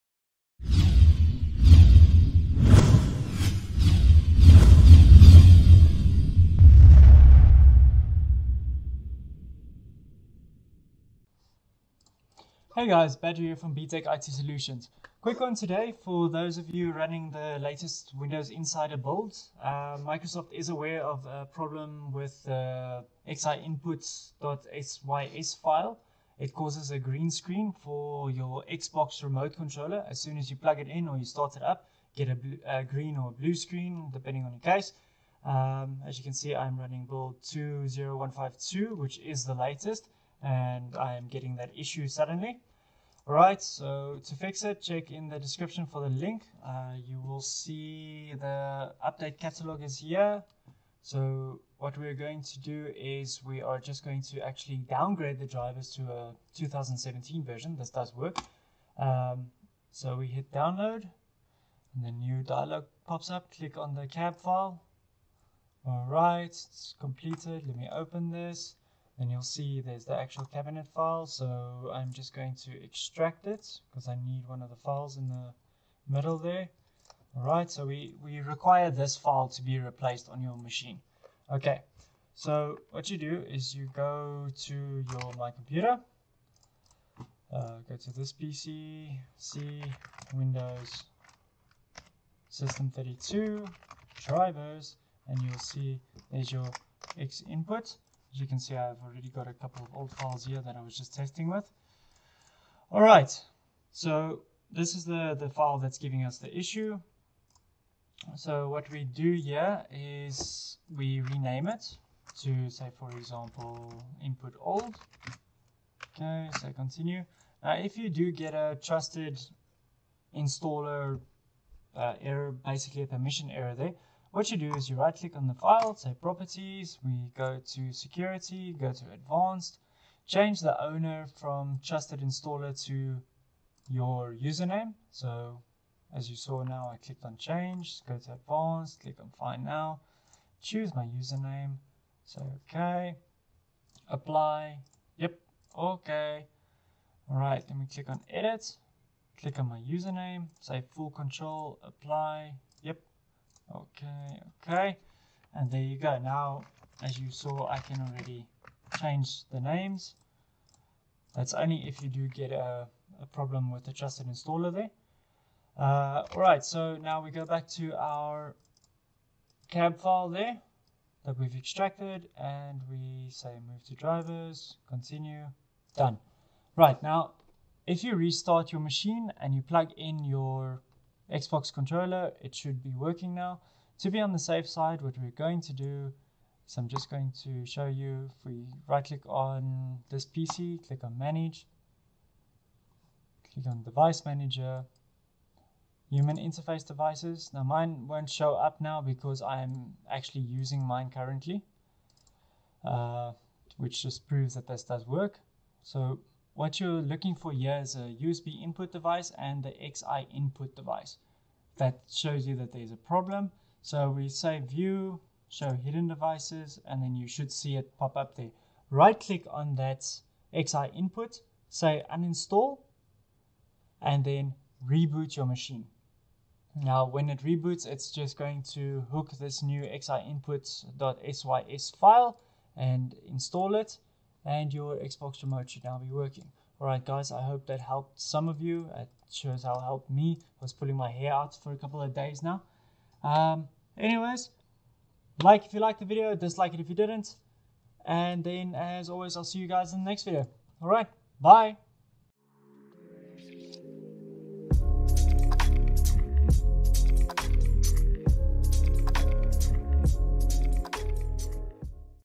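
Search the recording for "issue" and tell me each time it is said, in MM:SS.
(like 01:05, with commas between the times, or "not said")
00:41, 01:46.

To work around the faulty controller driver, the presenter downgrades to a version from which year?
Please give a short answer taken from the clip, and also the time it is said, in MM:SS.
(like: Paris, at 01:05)
2017, at 00:56.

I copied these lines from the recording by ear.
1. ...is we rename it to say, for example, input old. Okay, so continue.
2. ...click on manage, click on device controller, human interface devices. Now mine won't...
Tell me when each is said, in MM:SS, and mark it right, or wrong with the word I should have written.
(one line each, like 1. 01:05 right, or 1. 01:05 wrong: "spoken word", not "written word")
1. 01:49 right
2. 03:10 wrong: "manager", not "controller".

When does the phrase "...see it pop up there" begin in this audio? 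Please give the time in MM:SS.
03:37.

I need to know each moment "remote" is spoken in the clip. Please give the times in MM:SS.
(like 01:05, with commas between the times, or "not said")
00:29, 03:55.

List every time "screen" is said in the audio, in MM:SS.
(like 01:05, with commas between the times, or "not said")
00:27, 00:33.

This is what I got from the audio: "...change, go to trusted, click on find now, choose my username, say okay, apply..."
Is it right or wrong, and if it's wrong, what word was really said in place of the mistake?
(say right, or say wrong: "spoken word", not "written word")
wrong: "advanced", not "trusted".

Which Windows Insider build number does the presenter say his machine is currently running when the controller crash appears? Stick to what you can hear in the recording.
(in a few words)
20152.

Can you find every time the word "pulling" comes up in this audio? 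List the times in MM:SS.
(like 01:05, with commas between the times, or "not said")
04:00.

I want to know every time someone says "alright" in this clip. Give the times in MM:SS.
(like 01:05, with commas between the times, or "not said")
00:43, 01:17, 02:46, 03:56, 04:10.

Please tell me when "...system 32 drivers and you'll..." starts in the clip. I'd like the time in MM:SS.
01:32.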